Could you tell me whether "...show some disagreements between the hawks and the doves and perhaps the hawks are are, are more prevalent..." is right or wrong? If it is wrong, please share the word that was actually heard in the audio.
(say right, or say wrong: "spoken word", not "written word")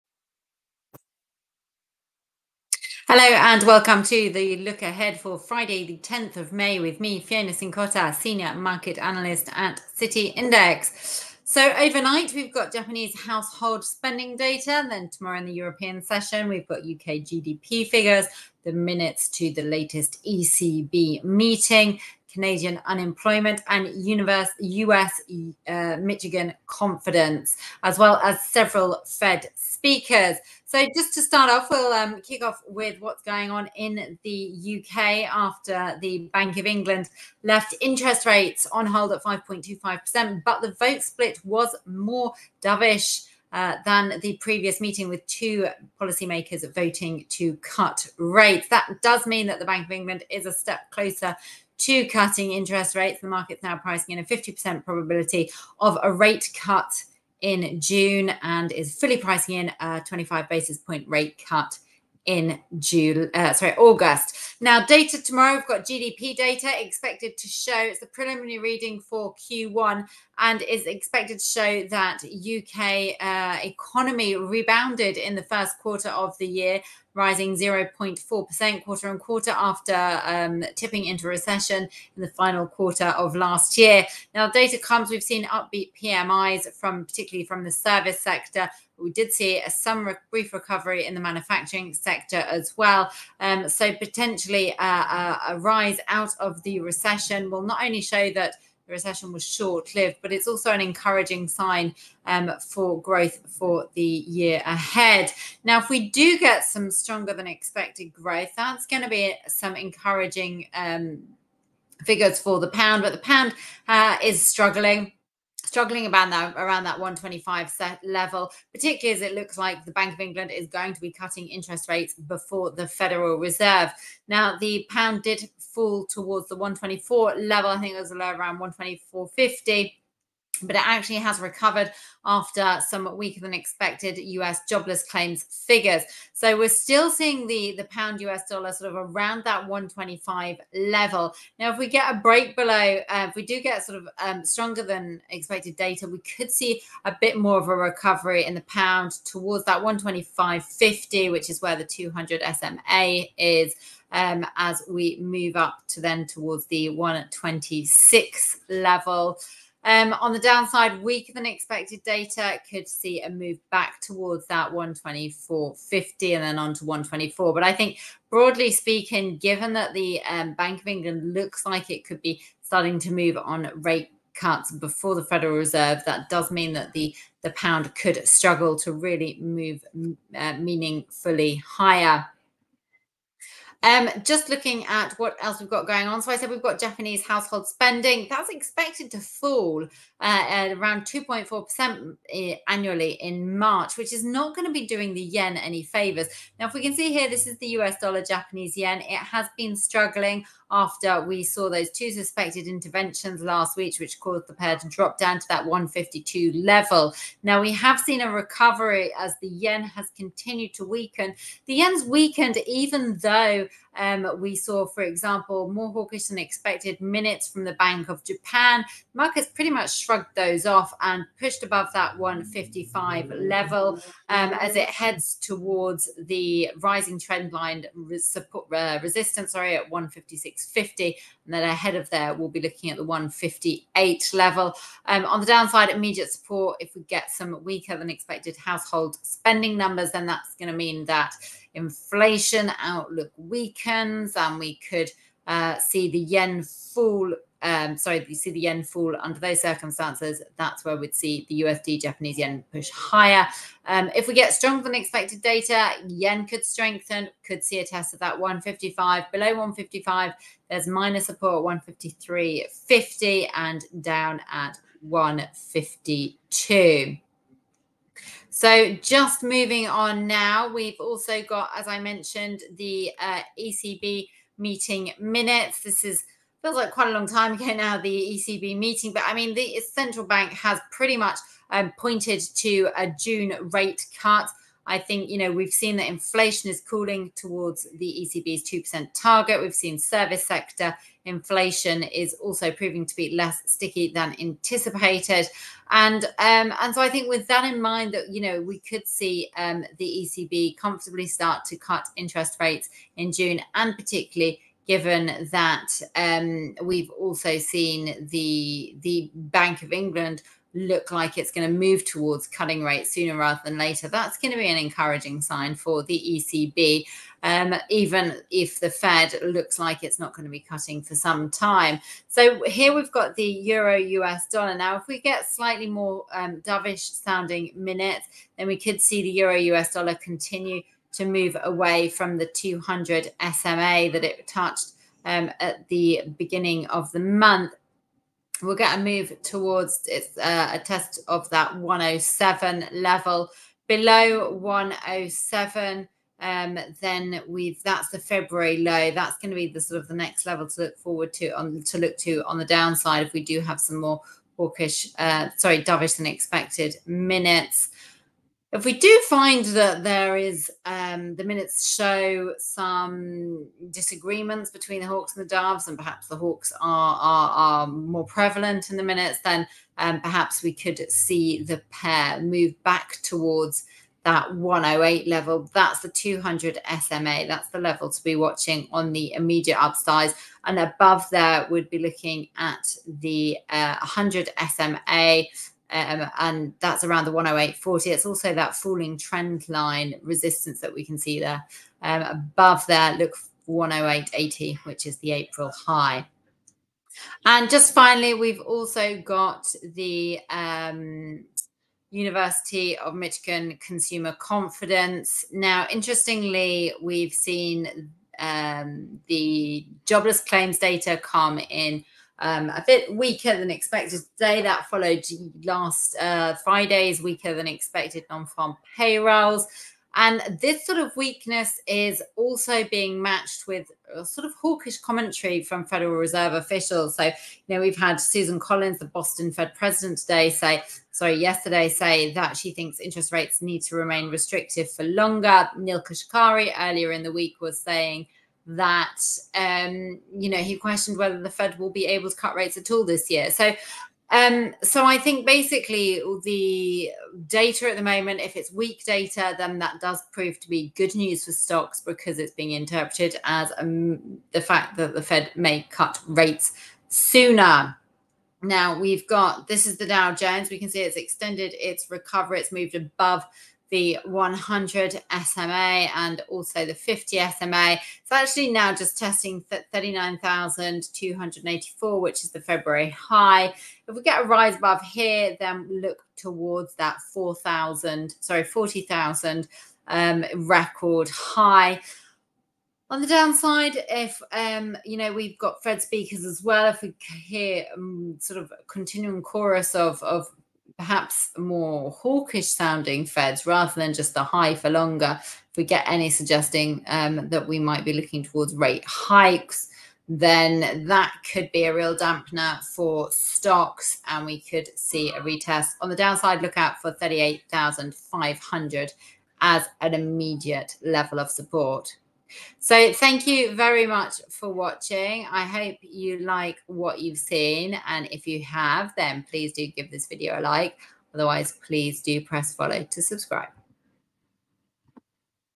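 right.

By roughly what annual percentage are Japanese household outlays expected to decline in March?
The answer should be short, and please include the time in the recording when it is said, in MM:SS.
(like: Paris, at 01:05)
2.4%, at 03:11.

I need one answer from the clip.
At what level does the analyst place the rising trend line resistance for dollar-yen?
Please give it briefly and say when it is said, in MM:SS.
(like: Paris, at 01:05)
156.50, at 03:49.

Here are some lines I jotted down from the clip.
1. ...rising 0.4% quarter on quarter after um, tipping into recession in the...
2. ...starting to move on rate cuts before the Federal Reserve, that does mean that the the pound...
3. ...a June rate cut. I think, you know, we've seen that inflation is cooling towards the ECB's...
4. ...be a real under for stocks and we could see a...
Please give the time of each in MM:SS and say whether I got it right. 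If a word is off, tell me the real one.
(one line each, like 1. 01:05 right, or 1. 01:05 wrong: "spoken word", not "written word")
1. 01:17 right
2. 02:52 right
3. 04:42 right
4. 08:21 wrong: "dampener", not "under".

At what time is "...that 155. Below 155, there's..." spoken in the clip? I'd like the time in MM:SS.
04:18.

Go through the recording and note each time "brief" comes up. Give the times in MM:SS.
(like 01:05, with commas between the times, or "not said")
01:30.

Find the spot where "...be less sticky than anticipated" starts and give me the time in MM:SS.
04:53.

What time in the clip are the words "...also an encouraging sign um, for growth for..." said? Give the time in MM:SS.
01:40.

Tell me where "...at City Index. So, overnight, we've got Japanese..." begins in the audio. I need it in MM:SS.
00:09.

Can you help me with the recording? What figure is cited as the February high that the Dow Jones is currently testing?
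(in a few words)
39,284.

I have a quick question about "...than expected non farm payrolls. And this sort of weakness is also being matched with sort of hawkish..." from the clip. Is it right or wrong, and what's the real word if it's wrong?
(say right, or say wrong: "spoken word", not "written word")
right.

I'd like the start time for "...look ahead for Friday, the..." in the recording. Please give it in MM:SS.
00:04.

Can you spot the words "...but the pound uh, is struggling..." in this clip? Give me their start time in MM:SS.
01:53.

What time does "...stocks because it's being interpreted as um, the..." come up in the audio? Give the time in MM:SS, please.
07:31.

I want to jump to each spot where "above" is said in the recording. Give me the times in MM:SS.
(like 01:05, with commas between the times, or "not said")
03:41, 06:20, 06:32, 07:42, 07:54.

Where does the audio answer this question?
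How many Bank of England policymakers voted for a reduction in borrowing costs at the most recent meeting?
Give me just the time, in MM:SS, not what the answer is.
00:45.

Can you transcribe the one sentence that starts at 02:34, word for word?
Um, as we move up to then towards the 126 level.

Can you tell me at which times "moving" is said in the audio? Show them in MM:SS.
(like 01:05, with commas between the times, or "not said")
04:29.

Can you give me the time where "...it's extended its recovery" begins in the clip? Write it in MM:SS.
07:41.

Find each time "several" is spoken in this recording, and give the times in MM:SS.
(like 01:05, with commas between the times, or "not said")
00:28.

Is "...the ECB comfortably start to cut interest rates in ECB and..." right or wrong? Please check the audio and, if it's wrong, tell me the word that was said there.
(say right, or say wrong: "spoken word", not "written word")
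wrong: "June", not "ECB".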